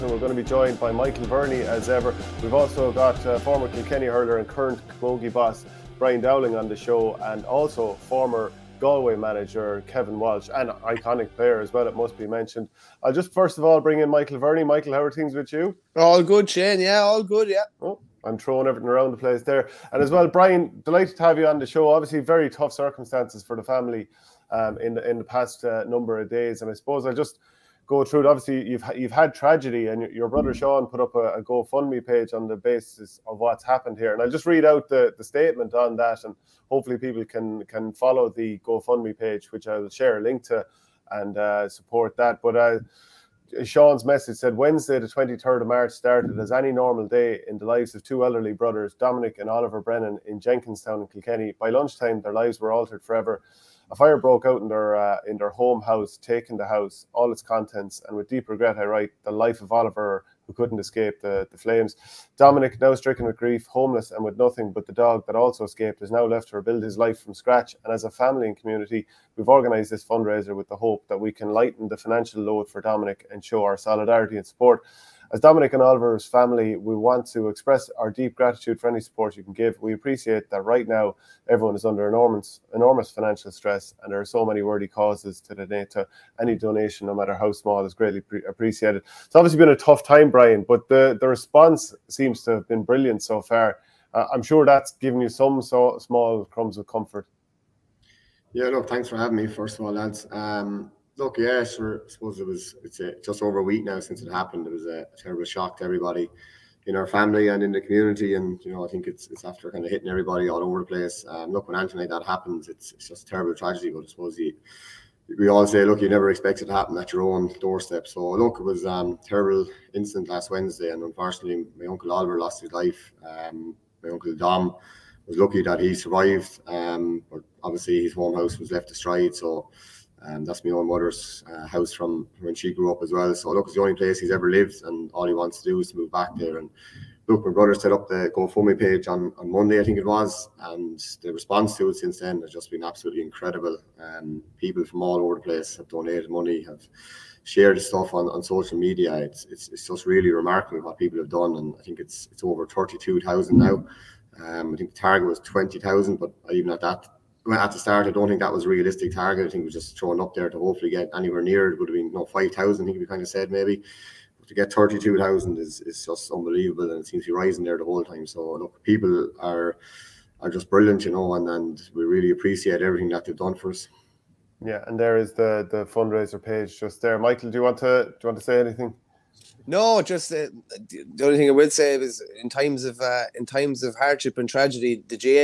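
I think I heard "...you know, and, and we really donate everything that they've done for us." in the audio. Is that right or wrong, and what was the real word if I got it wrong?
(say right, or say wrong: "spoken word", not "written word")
wrong: "appreciate", not "donate".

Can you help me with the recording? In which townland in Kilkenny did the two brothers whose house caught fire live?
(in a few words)
Jenkinstown.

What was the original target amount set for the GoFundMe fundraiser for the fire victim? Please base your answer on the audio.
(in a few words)
20,000.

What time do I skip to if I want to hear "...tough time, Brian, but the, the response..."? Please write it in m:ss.
1:29.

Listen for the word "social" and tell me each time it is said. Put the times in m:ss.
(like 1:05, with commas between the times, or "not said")
2:28.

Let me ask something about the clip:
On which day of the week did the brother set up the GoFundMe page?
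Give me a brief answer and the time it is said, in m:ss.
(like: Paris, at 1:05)
Monday, at 2:19.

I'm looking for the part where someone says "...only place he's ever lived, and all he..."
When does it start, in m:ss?
2:13.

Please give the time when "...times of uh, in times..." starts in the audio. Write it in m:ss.
3:02.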